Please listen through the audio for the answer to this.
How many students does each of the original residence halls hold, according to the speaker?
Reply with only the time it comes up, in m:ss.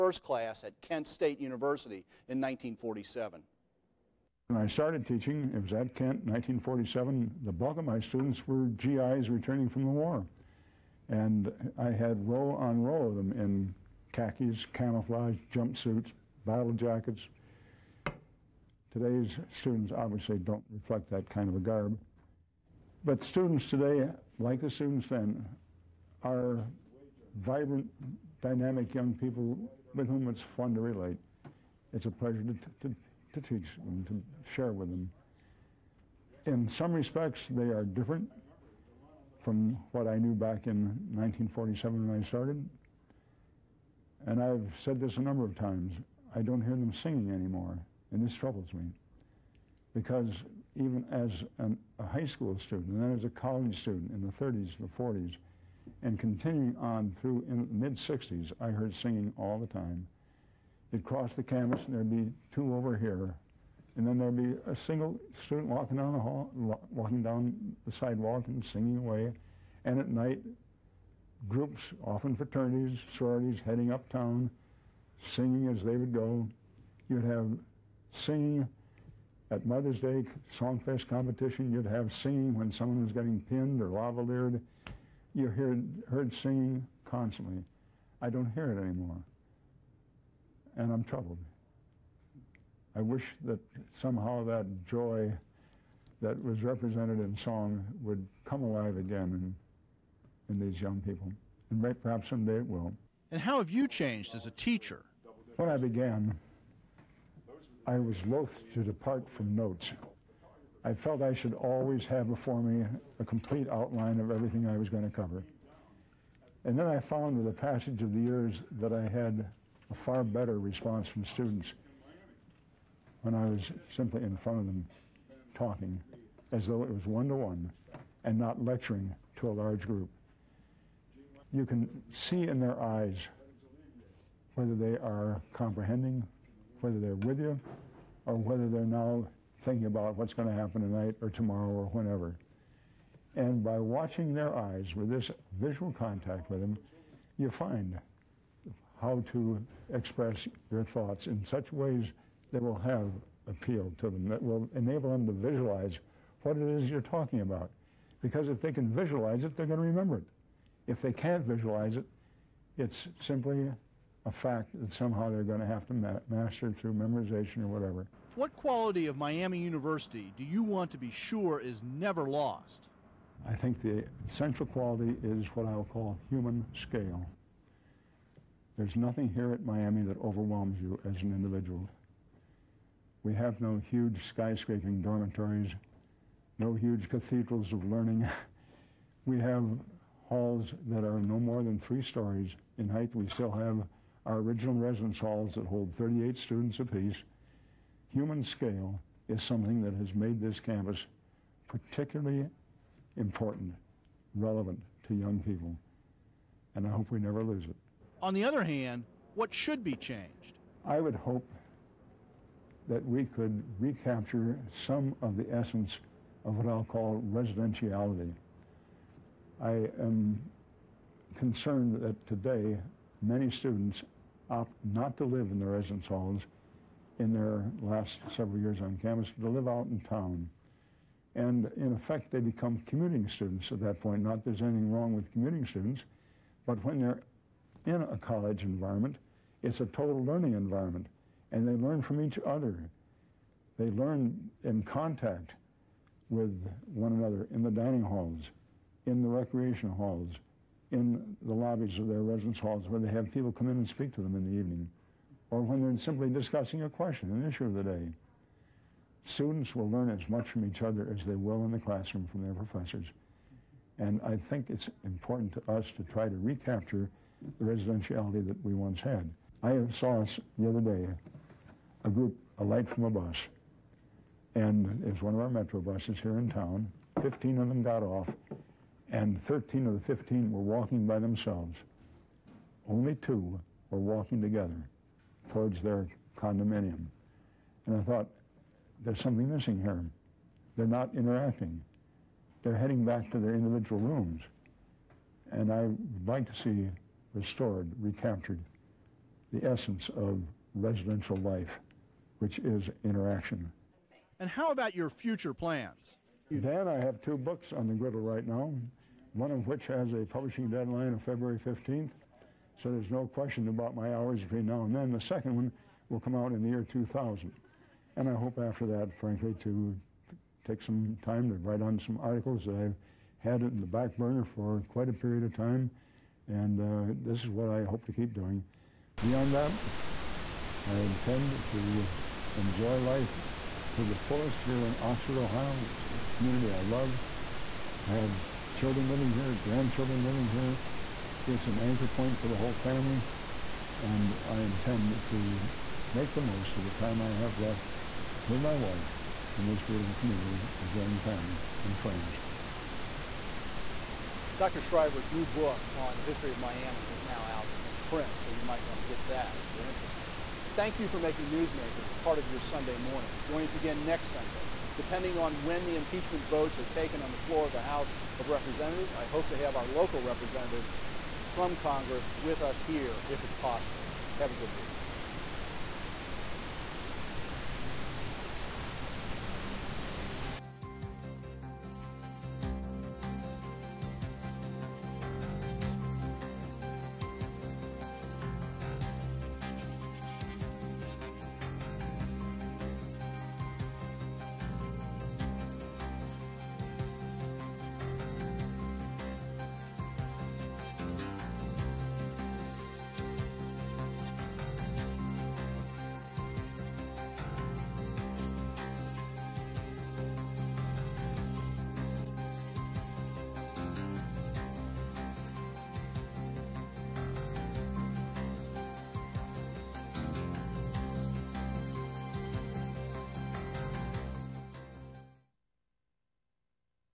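3:15.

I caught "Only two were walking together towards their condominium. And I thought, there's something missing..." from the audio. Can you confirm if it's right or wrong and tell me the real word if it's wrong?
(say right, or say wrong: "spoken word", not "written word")
right.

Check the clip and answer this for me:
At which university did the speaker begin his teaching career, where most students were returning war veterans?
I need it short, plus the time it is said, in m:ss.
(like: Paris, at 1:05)
Kent State University, at 0:00.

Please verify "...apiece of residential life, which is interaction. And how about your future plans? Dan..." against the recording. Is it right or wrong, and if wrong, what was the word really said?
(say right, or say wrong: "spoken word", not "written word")
wrong: "essence", not "apiece".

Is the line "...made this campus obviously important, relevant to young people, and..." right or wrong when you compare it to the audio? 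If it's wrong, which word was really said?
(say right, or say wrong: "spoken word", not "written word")
wrong: "particularly", not "obviously".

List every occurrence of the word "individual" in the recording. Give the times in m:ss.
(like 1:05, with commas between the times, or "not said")
3:01, 4:53.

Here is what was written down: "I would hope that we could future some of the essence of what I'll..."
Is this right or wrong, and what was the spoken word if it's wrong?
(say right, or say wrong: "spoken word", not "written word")
wrong: "recapture", not "future".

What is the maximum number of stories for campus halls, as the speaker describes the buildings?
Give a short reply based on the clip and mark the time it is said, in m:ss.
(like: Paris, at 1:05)
3, at 3:11.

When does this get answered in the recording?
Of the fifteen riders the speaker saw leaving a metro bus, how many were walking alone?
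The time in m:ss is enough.
4:39.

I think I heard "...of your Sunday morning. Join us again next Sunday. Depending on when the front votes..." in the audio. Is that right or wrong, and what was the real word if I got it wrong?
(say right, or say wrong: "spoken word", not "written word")
wrong: "impeachment", not "front".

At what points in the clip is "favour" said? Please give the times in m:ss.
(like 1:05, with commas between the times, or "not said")
not said.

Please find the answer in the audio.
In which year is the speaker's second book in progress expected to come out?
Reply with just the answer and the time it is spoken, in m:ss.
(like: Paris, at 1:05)
2000, at 5:16.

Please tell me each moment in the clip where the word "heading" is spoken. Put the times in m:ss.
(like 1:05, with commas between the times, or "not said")
1:13, 4:52.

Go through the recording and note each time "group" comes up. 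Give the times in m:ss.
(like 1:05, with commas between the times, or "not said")
1:11, 2:09, 4:32.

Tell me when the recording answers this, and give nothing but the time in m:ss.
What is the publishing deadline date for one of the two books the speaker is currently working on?
5:11.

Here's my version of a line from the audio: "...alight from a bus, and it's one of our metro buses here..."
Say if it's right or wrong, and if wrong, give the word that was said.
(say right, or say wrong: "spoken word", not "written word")
right.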